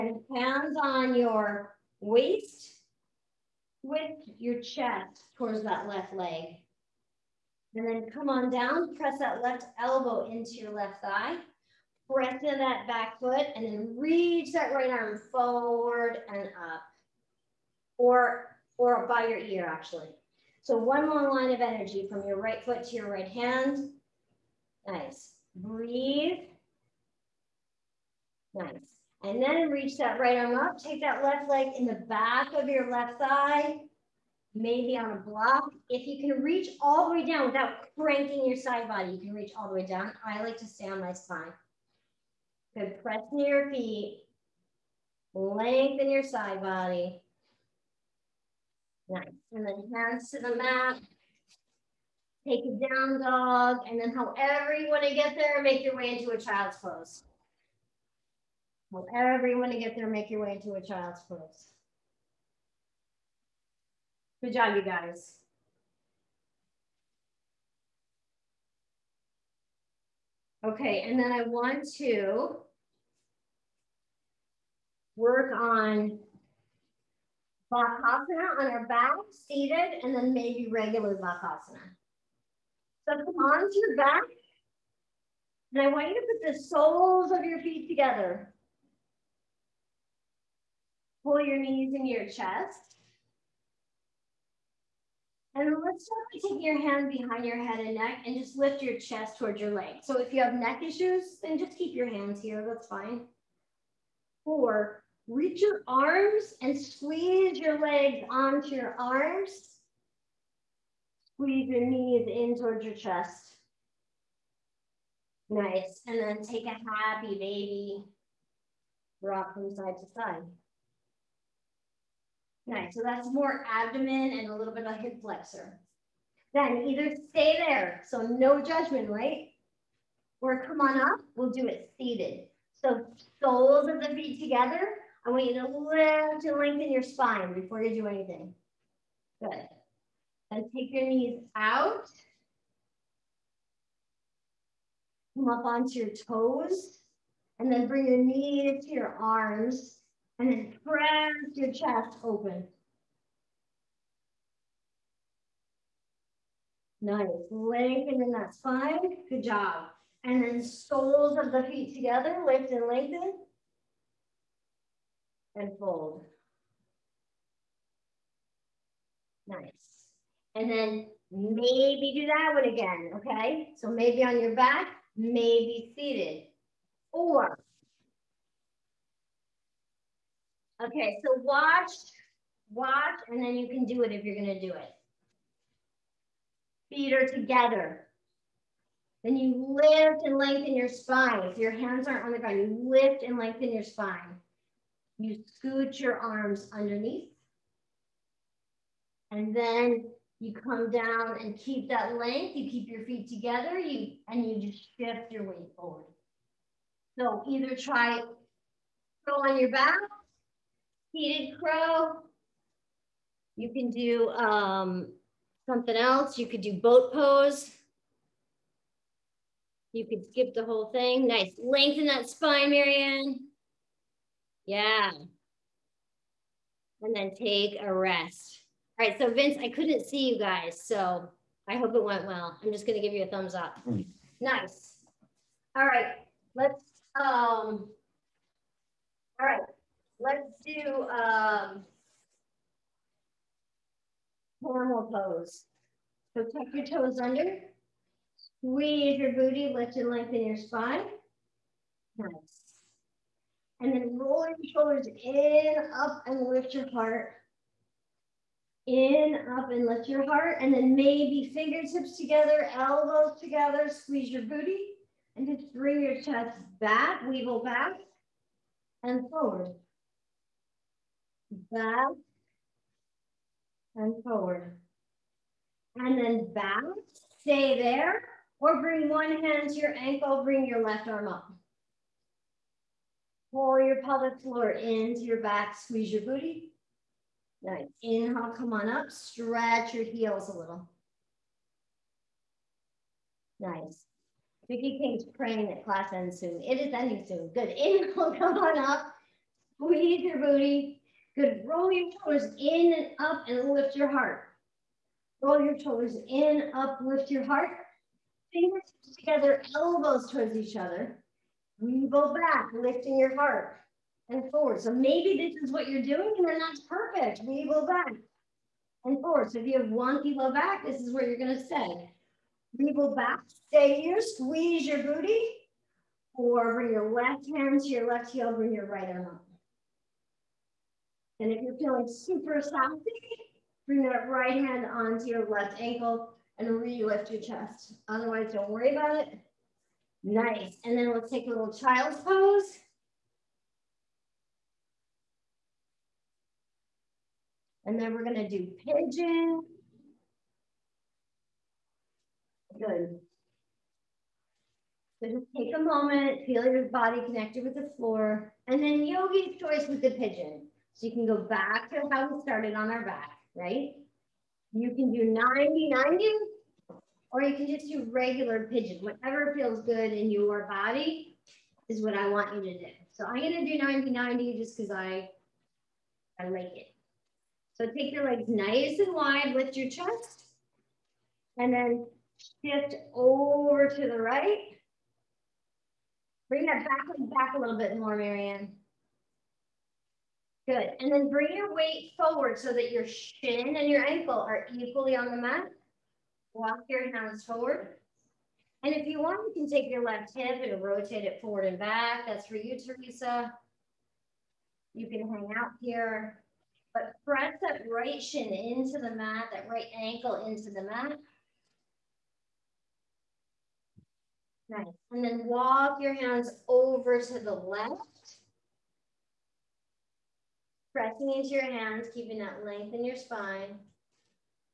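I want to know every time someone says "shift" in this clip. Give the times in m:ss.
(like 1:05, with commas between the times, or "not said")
3:24, 6:22.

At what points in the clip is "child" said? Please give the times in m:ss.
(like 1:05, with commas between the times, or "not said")
0:56, 1:00, 5:41.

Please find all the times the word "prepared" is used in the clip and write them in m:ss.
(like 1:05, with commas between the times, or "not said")
not said.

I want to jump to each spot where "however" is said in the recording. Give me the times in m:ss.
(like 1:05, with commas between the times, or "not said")
0:54, 0:59.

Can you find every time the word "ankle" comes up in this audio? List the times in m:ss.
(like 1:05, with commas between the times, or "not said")
4:39, 5:35, 6:34, 6:49.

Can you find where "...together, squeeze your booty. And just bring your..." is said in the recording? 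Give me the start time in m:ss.
4:23.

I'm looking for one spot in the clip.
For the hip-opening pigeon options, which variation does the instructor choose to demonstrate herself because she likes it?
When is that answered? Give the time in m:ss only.
6:13.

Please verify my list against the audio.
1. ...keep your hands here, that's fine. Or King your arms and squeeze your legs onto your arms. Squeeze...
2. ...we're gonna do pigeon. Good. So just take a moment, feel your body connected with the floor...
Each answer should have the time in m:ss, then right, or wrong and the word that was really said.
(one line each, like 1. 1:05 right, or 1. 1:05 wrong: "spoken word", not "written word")
1. 1:41 wrong: "Reach", not "King"
2. 5:48 right.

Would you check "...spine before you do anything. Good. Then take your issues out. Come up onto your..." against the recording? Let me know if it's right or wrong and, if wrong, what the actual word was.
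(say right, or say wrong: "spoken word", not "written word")
wrong: "knees", not "issues".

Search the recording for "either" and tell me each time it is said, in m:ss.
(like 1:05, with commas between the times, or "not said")
2:06, 3:27.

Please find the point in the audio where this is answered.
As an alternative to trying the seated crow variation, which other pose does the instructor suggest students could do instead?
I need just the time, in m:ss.
3:36.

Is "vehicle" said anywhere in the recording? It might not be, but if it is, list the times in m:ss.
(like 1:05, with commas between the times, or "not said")
not said.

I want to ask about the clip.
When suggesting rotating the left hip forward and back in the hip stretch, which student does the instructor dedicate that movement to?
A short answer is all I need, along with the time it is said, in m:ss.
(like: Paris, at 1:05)
Teresa, at 6:42.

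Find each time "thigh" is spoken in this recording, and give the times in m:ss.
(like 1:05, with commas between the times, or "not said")
0:11, 0:33.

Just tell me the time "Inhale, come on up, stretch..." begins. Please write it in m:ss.
4:48.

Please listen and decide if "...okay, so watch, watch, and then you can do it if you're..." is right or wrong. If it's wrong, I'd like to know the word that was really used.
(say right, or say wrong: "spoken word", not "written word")
right.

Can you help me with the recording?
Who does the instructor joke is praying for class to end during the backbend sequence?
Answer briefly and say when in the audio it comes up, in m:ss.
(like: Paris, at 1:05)
Vicky King, at 4:54.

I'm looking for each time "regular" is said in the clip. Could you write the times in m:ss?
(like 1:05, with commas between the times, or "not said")
1:20, 6:08.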